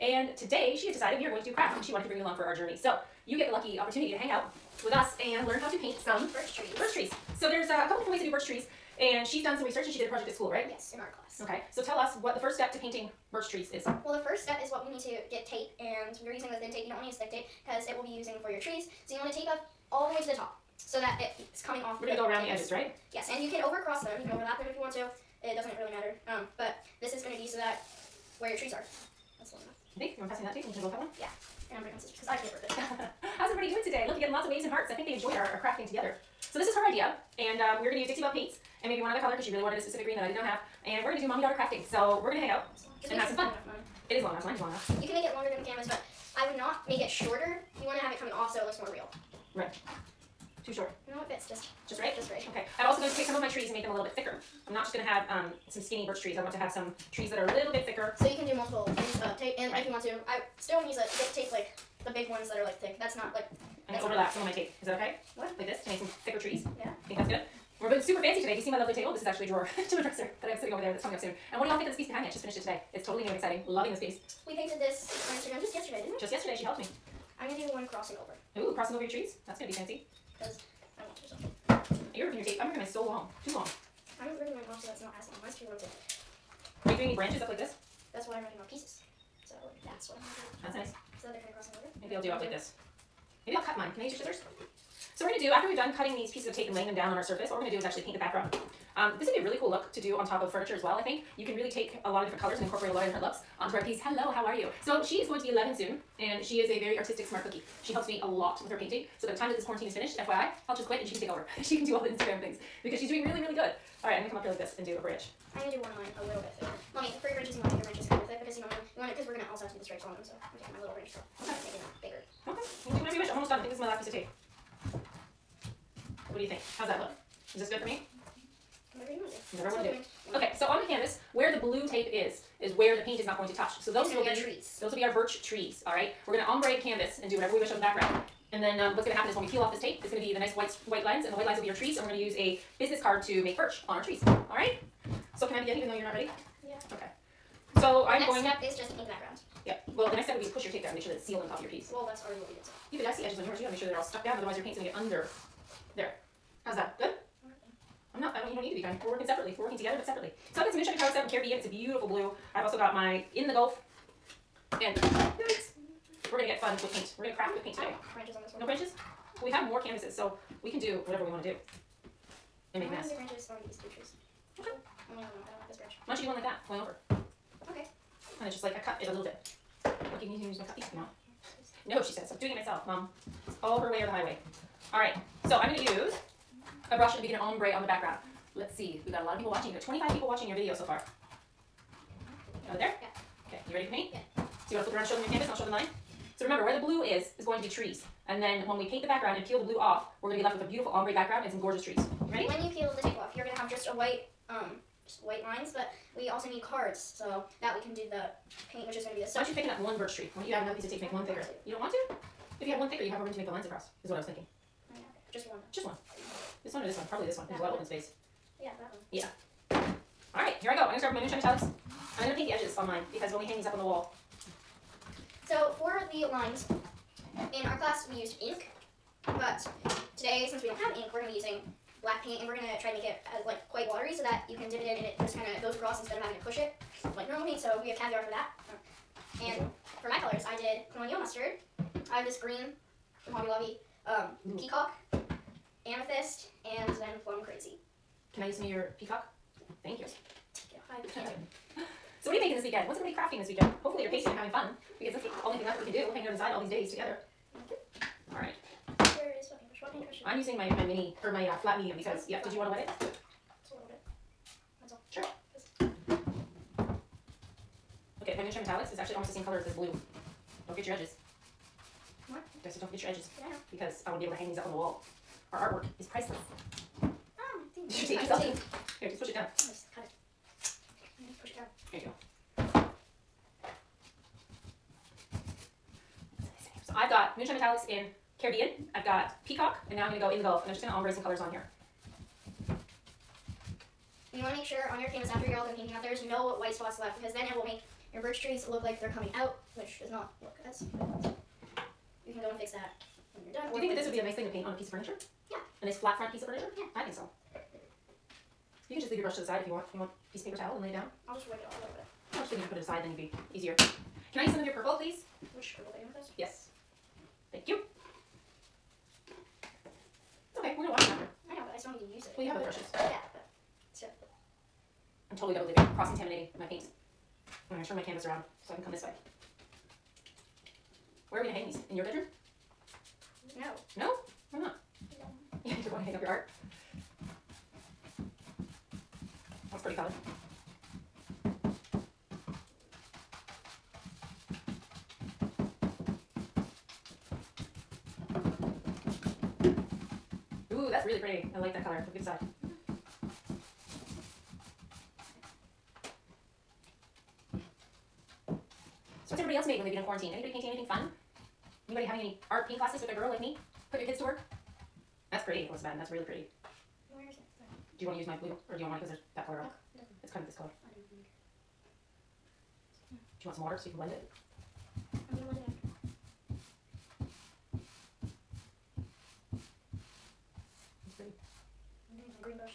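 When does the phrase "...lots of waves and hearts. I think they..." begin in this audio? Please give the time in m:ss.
0:34.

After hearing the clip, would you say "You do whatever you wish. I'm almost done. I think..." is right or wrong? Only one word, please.
right.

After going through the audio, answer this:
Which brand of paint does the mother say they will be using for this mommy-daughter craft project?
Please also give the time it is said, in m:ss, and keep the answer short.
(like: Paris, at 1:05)
Dixie Belle, at 0:38.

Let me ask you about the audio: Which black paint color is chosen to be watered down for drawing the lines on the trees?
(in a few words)
Caviar.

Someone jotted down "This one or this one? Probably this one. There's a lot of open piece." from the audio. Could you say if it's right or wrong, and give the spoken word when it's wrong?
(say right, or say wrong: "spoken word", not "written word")
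wrong: "space", not "piece".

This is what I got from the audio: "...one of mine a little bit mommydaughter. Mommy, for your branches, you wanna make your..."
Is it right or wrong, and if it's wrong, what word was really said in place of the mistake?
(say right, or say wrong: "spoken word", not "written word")
wrong: "thicker", not "mommydaughter".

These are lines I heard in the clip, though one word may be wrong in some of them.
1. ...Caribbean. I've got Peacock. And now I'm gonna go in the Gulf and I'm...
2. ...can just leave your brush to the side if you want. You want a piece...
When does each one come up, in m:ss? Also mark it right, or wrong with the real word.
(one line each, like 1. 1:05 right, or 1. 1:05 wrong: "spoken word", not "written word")
1. 4:48 right
2. 5:08 right.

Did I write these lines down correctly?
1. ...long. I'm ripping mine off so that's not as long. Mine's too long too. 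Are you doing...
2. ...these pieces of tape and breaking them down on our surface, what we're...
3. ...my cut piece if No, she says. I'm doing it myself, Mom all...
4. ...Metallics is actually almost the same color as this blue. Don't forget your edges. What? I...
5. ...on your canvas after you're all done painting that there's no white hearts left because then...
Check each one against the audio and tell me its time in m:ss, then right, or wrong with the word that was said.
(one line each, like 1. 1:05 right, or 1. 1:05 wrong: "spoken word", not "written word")
1. 1:23 right
2. 1:36 wrong: "laying", not "breaking"
3. 3:00 right
4. 4:28 right
5. 4:54 wrong: "spots", not "hearts".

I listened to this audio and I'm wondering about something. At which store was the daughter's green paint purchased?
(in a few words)
Hobby Lobby.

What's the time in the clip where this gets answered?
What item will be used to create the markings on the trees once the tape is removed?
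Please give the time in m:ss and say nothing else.
2:22.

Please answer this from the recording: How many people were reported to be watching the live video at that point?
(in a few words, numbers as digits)
25.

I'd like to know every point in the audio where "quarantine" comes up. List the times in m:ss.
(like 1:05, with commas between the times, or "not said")
1:49, 6:00.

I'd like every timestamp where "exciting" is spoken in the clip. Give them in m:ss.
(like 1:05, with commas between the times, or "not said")
1:13.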